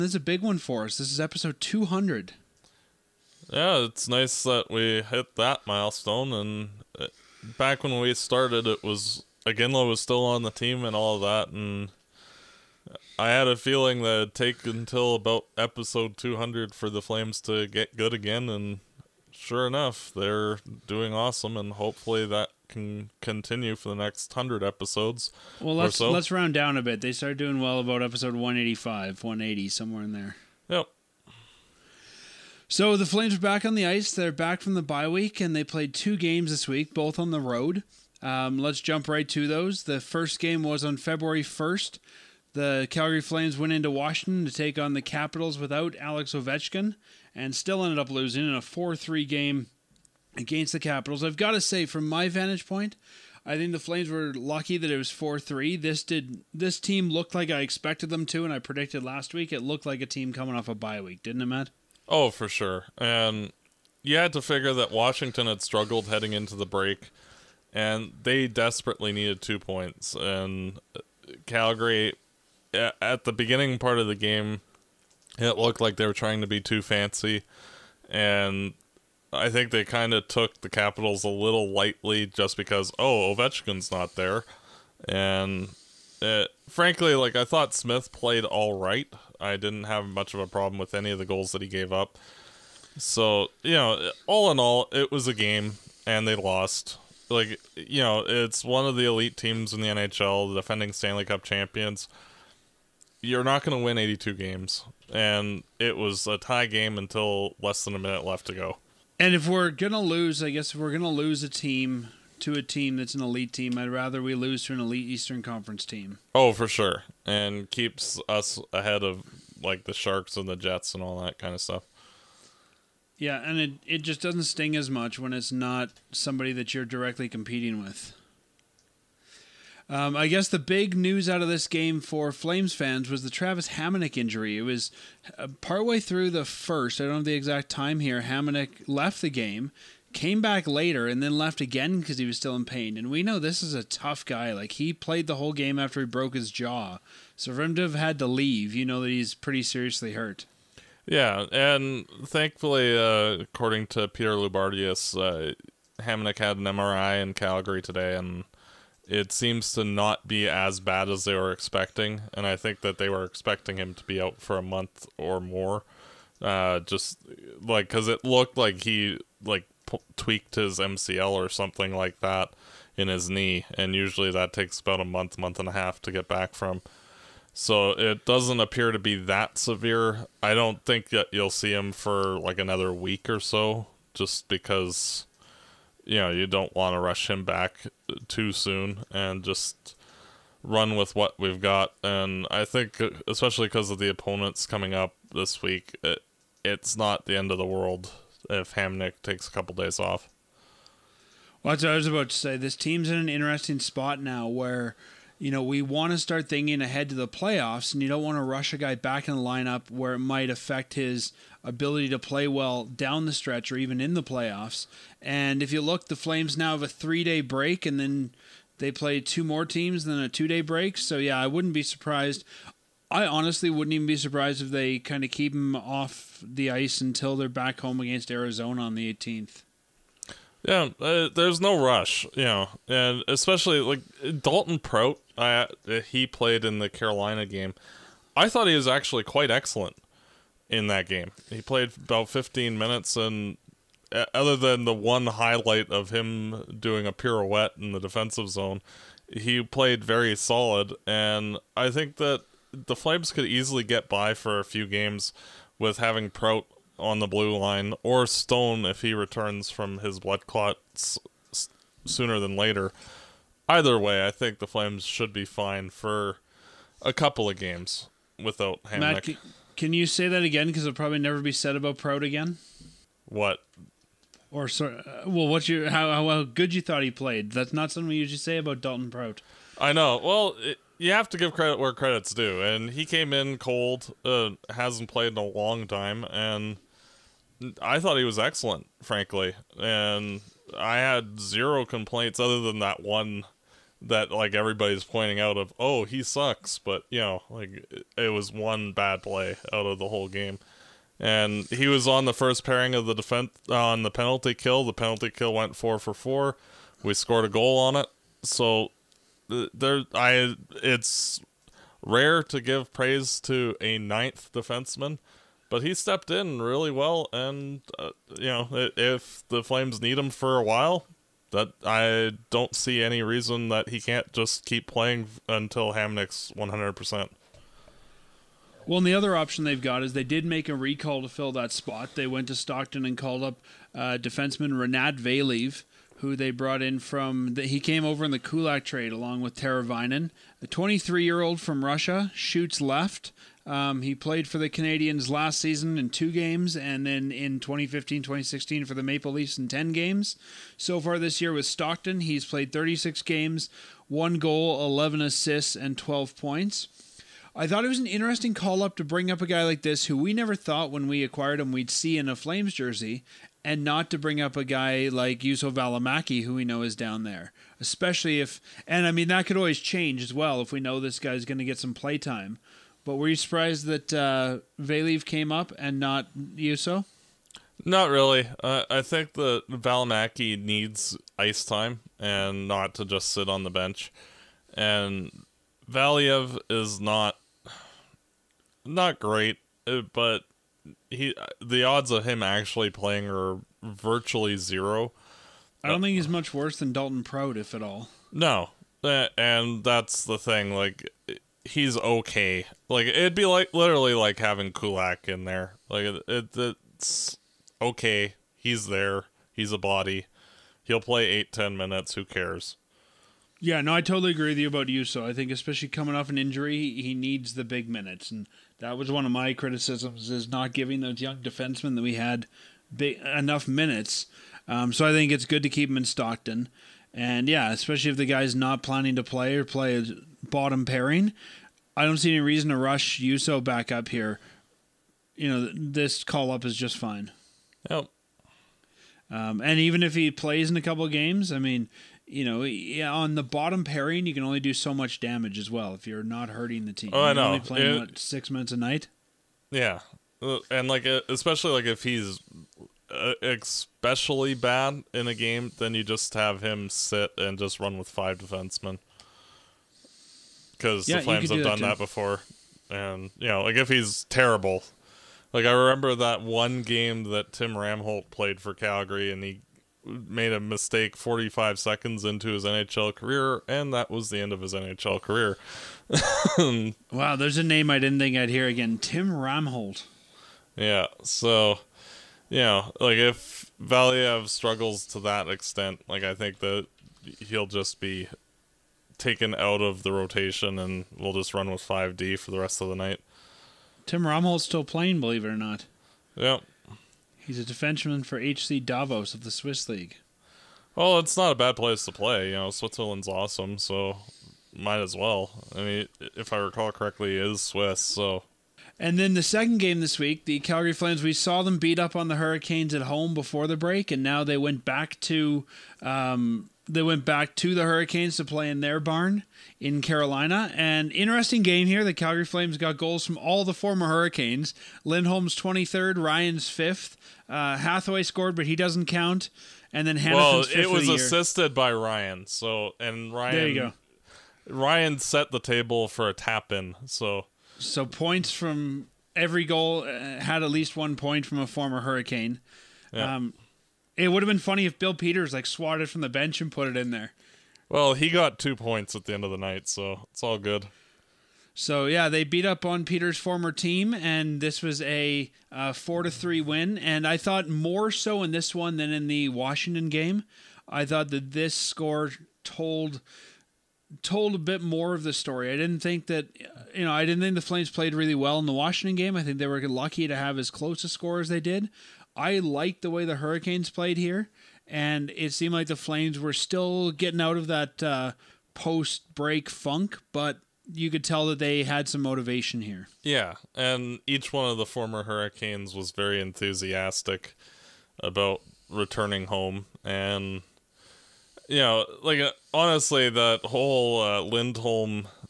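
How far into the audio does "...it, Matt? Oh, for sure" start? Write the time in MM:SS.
01:01.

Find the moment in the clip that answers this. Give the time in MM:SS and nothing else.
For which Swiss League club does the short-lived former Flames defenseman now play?
08:18.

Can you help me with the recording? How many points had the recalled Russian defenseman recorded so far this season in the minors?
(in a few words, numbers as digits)
12.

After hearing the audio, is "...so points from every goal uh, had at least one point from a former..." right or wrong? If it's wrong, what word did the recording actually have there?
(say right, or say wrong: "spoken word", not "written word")
right.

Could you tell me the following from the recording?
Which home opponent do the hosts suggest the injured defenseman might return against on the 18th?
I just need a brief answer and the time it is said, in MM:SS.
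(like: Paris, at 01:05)
Arizona, at 03:48.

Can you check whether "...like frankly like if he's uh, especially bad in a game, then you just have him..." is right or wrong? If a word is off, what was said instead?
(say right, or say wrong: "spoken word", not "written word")
wrong: "especially", not "frankly".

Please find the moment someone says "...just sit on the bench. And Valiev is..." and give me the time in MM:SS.
06:23.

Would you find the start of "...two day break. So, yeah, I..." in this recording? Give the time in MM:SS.
03:40.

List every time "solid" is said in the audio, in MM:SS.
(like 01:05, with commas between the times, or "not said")
04:10.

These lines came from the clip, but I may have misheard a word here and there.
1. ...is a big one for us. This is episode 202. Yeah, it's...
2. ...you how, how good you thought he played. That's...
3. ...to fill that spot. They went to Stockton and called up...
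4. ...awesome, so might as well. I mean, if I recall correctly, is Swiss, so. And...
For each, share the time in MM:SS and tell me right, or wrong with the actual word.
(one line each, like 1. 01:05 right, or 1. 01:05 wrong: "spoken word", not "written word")
1. 00:00 wrong: "200", not "202"
2. 04:35 right
3. 05:31 right
4. 08:23 right.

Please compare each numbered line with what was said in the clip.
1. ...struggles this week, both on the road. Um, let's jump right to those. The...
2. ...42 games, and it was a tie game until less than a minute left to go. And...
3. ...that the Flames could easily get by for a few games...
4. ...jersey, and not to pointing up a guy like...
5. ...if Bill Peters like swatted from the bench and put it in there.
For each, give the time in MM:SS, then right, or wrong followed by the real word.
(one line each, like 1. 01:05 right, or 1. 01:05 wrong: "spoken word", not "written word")
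1. 00:36 wrong: "games", not "struggles"
2. 01:43 wrong: "82", not "42"
3. 04:12 right
4. 06:02 wrong: "bring", not "pointing"
5. 09:04 right.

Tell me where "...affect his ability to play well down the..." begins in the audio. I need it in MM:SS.
03:30.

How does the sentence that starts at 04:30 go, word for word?
Because it'll probably never be said about Prout again.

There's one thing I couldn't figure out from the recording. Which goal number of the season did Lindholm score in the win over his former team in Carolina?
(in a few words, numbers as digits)
23rd.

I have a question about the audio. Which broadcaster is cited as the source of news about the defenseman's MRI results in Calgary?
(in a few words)
Peter Loubardias.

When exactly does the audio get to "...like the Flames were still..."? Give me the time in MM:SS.
09:35.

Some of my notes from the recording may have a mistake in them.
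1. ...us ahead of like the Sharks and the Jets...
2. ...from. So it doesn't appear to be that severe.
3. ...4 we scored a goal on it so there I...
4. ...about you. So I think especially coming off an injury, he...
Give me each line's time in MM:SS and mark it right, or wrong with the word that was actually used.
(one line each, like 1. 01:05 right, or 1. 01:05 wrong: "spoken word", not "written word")
1. 01:58 right
2. 02:56 right
3. 05:06 right
4. 06:54 right.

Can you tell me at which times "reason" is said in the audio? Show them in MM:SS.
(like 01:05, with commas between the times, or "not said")
05:23, 07:12.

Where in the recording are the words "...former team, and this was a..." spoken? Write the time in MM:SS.
09:13.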